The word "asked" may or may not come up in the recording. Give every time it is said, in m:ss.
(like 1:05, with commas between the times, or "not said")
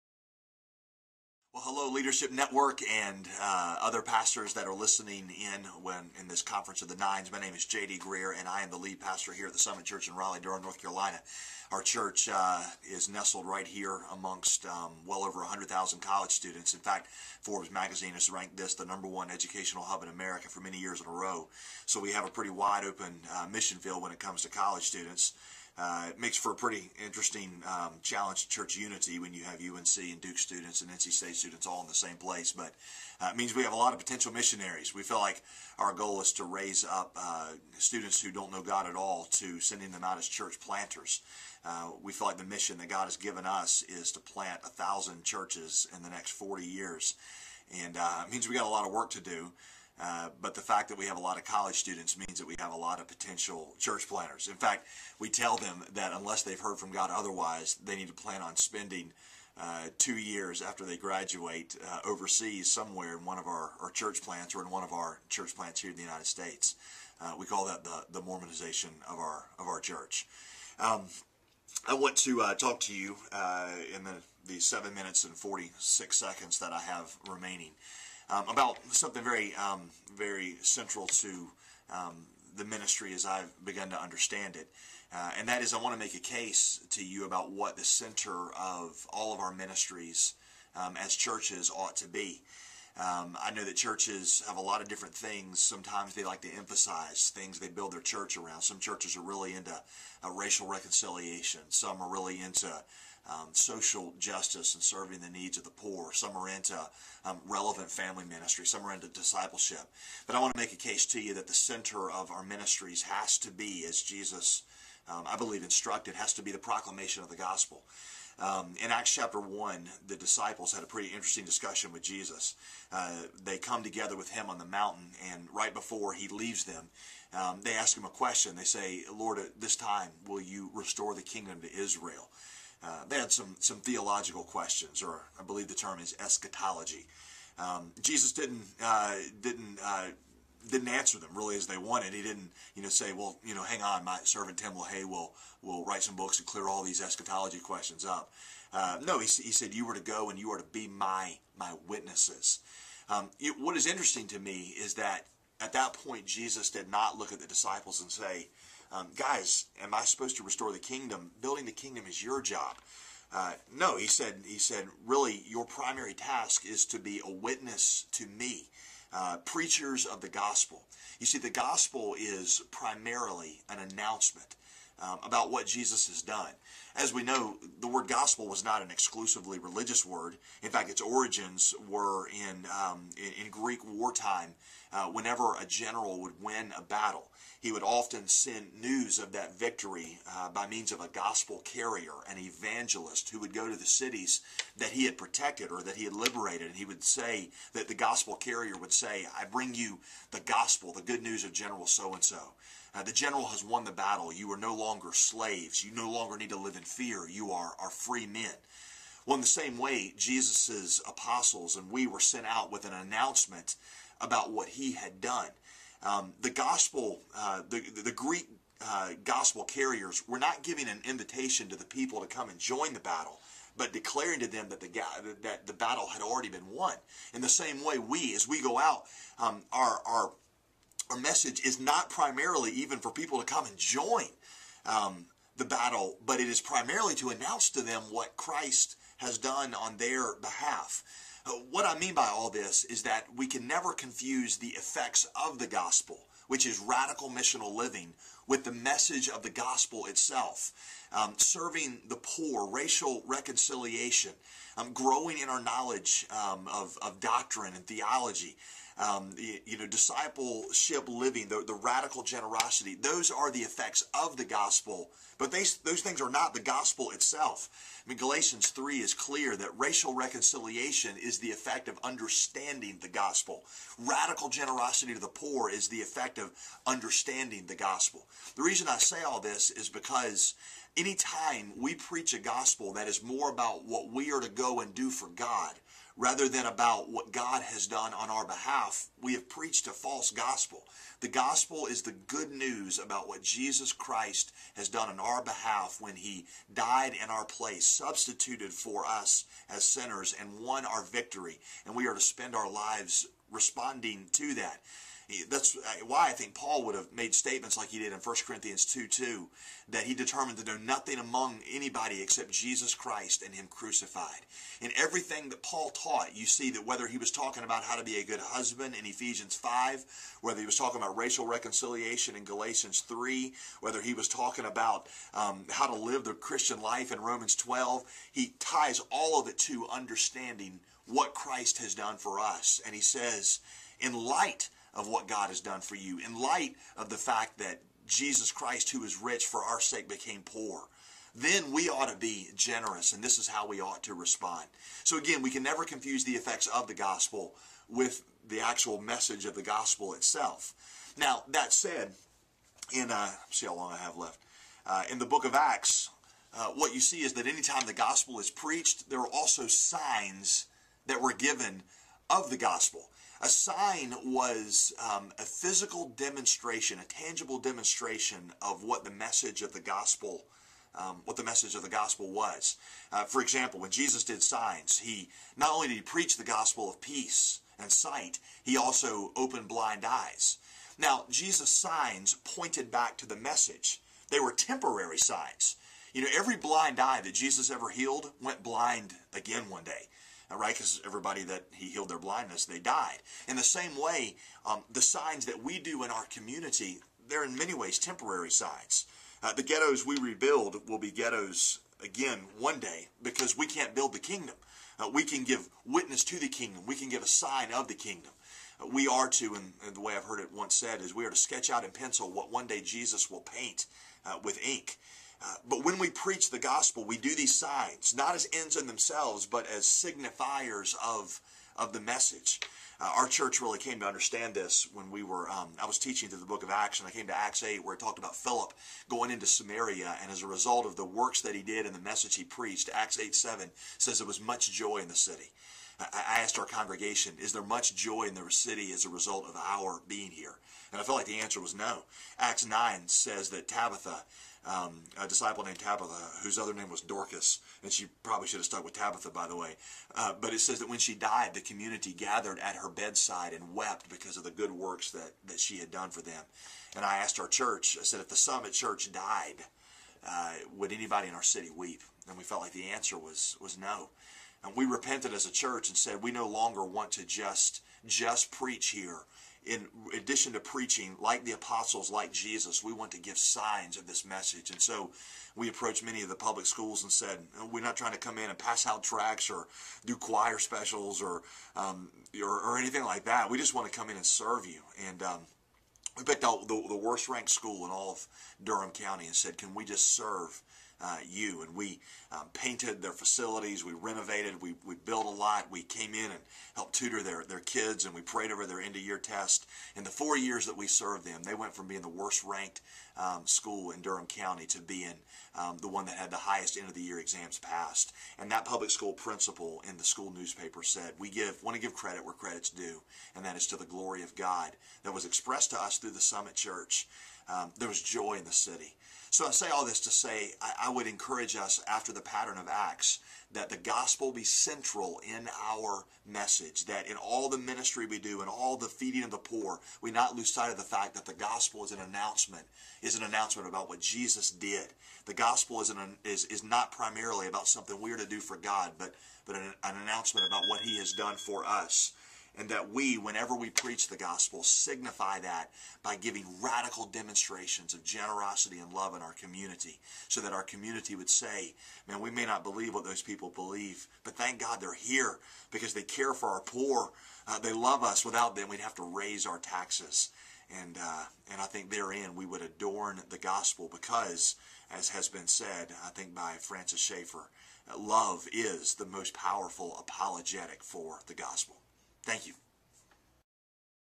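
7:16, 7:37.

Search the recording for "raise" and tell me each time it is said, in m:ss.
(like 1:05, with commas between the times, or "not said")
0:36, 9:19.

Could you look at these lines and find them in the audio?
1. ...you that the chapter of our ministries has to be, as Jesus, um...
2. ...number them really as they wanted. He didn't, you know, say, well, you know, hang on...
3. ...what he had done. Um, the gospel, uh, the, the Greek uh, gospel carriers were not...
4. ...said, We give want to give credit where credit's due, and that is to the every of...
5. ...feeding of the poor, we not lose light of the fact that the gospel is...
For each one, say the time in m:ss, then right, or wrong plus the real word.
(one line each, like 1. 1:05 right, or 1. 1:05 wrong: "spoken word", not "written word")
1. 1:51 wrong: "center", not "chapter"
2. 2:20 wrong: "answer", not "number"
3. 3:34 right
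4. 8:30 wrong: "glory", not "every"
5. 8:48 wrong: "sight", not "light".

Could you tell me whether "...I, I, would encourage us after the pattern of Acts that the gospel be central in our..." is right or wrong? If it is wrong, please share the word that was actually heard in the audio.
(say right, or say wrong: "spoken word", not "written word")
right.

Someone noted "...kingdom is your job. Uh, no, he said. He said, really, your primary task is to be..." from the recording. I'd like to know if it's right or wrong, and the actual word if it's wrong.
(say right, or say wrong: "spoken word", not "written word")
right.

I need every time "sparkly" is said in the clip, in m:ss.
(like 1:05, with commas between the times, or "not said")
not said.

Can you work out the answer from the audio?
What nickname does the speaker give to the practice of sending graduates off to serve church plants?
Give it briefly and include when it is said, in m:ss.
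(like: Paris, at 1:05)
Mormonization, at 1:08.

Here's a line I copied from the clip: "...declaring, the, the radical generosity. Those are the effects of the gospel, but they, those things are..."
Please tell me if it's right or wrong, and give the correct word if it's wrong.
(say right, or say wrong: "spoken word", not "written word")
wrong: "living", not "declaring".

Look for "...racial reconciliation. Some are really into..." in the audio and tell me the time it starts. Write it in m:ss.
1:40.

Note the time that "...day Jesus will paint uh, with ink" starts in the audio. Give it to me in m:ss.
6:52.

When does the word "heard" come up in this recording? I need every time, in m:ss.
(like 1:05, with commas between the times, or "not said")
0:56, 6:50.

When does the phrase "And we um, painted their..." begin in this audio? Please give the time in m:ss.
8:11.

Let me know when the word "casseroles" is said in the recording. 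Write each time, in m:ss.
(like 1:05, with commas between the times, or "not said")
not said.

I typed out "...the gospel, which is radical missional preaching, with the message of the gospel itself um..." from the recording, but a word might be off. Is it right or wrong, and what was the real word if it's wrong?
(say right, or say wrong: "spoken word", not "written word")
wrong: "living", not "preaching".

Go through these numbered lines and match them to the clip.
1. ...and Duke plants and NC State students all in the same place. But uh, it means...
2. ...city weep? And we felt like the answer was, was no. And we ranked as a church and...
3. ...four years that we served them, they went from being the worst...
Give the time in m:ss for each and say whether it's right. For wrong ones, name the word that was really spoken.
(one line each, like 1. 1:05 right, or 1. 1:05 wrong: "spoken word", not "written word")
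1. 0:30 wrong: "students", not "plants"
2. 7:41 wrong: "repented", not "ranked"
3. 8:20 right.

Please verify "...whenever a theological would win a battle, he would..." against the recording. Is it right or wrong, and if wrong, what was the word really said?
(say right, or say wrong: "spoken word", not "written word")
wrong: "general", not "theological".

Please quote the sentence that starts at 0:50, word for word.
Uh, but the fact that we have a lot of college students means that we have a lot of potential church planters.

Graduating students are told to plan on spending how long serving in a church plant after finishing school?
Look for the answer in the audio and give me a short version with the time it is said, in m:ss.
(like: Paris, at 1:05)
2 years, at 0:59.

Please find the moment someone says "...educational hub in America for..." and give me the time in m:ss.
0:19.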